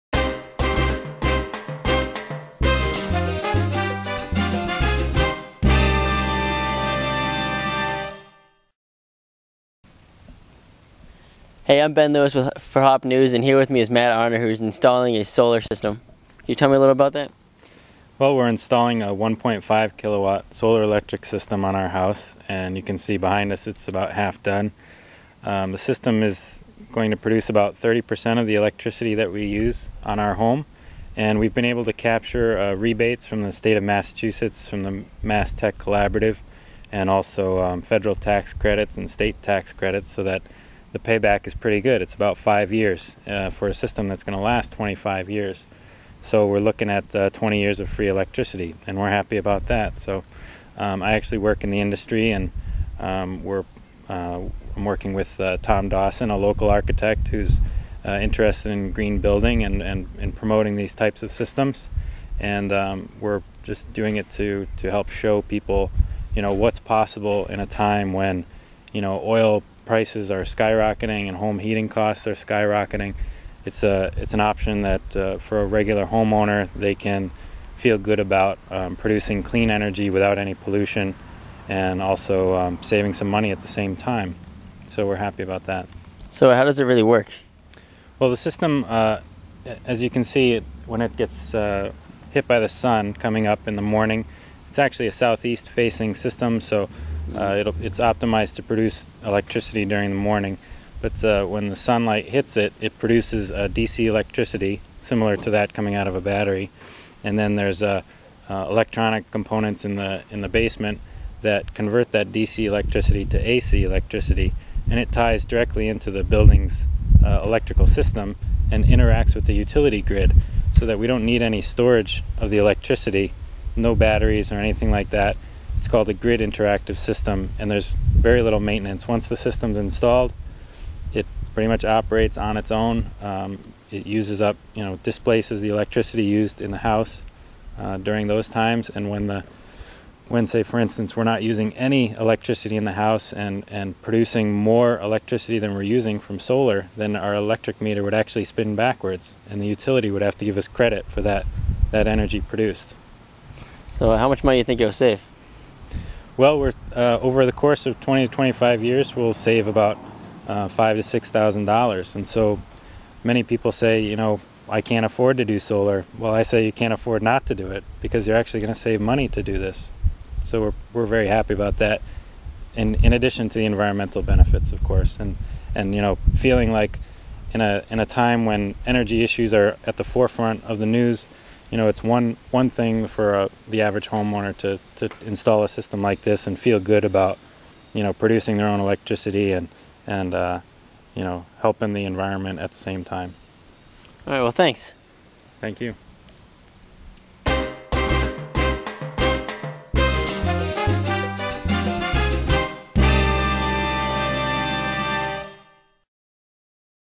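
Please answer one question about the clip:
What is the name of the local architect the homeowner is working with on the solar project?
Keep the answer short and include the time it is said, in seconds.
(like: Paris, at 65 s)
Tom Dawson, at 55 s.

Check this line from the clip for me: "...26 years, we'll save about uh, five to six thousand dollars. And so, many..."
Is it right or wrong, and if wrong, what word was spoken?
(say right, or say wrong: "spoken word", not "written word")
wrong: "25", not "26".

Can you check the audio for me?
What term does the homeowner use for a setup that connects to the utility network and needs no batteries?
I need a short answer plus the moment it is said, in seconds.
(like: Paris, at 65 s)
grid interactive system, at 126 s.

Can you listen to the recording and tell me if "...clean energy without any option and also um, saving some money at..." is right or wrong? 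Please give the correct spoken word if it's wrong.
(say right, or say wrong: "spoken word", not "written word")
wrong: "pollution", not "option".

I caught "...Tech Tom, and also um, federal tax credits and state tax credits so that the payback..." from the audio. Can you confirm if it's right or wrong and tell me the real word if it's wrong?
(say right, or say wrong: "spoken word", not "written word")
wrong: "Collaborative", not "Tom".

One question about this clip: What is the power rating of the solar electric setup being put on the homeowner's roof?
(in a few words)
1.5 kilowatt.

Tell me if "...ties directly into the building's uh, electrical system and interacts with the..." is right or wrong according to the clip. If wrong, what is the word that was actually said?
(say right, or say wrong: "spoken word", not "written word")
right.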